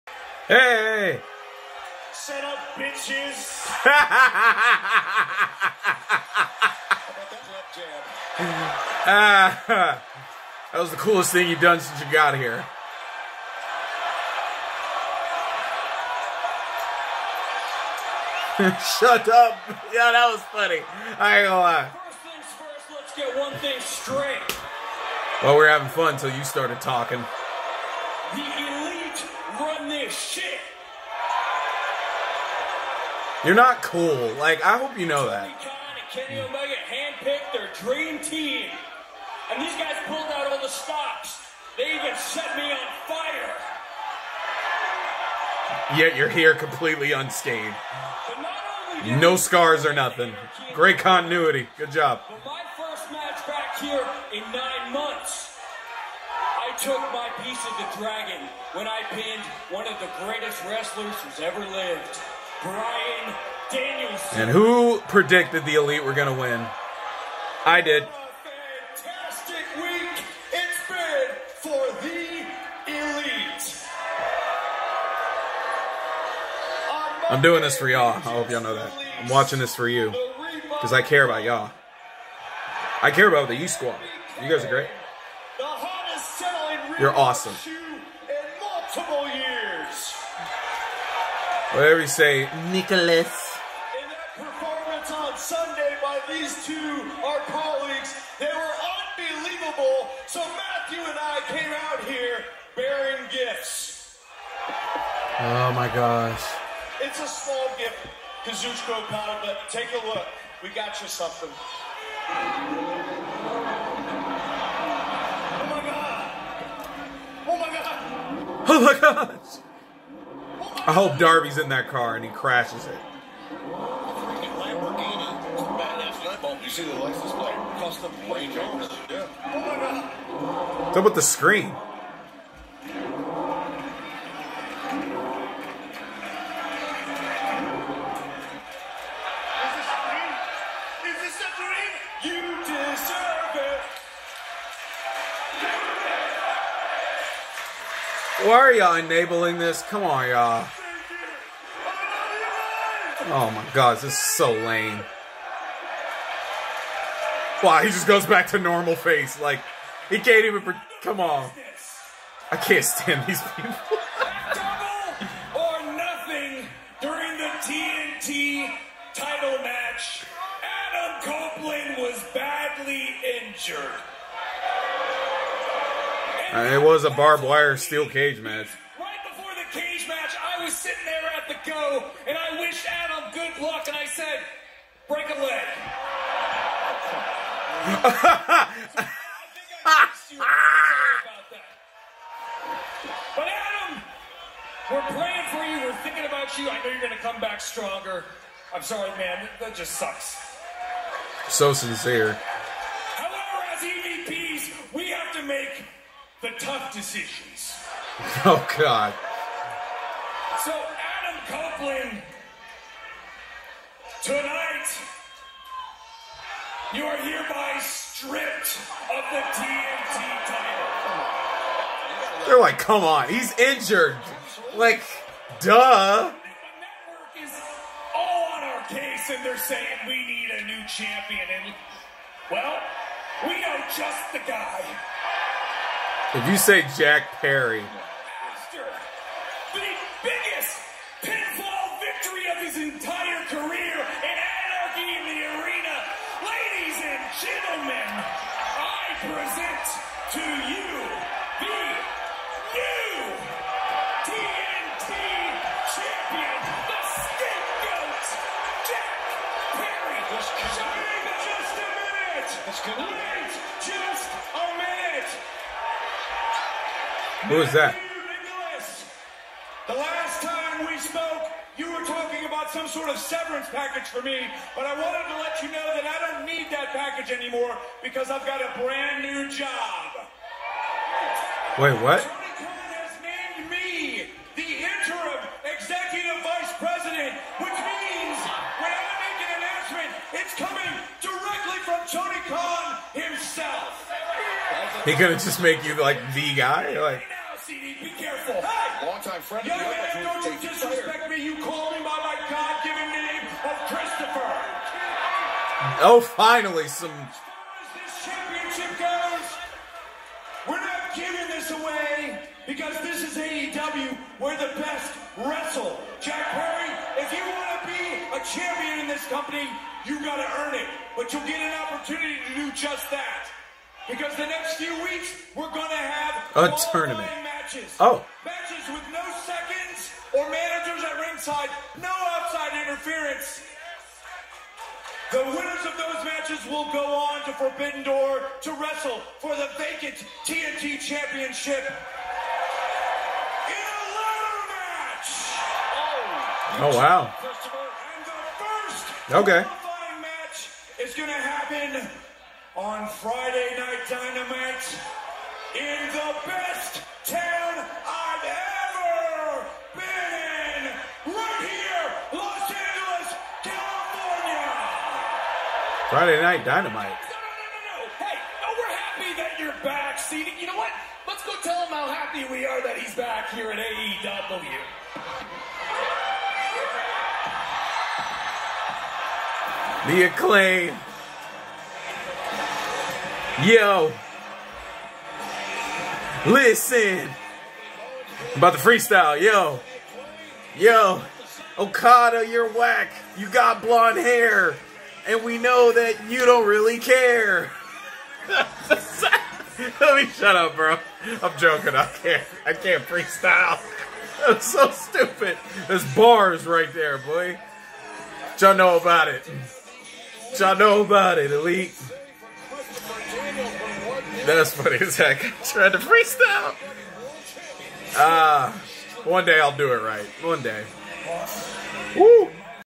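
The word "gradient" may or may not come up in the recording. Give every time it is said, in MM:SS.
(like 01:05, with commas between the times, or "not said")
not said.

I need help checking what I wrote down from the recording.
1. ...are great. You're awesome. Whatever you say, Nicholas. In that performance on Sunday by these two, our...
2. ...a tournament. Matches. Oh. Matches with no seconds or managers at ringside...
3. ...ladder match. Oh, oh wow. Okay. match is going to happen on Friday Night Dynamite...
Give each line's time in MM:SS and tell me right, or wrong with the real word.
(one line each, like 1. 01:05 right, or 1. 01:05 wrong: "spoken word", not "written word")
1. 01:24 right
2. 05:26 right
3. 05:44 right.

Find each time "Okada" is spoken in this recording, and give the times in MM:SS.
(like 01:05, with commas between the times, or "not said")
01:49, 06:31.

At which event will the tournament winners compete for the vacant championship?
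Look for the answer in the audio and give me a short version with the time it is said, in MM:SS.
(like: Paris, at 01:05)
Forbidden Door, at 05:37.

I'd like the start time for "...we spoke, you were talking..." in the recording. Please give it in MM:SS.
04:30.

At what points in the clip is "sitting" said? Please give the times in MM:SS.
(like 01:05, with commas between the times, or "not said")
03:00.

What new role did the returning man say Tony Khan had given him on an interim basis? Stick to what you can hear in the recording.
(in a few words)
Executive vice president.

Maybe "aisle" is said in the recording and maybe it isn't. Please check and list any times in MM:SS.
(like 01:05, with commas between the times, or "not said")
not said.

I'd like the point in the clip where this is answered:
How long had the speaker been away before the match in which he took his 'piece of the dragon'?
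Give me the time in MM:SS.
00:54.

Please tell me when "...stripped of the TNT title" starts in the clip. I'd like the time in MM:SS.
03:37.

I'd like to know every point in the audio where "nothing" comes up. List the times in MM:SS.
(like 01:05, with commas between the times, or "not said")
00:49, 02:45.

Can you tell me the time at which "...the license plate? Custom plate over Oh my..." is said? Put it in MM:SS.
02:06.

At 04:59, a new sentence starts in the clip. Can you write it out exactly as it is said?
Longtime friend Young man, don't you disrespect me.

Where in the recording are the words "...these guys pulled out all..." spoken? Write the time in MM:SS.
00:39.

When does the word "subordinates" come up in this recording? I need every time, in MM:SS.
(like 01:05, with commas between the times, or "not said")
not said.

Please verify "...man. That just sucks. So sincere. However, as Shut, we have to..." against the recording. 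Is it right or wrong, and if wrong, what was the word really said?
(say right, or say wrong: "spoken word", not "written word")
wrong: "EVPs", not "Shut".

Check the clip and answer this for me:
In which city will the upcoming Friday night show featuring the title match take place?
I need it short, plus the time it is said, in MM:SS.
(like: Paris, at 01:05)
Los Angeles, at 06:02.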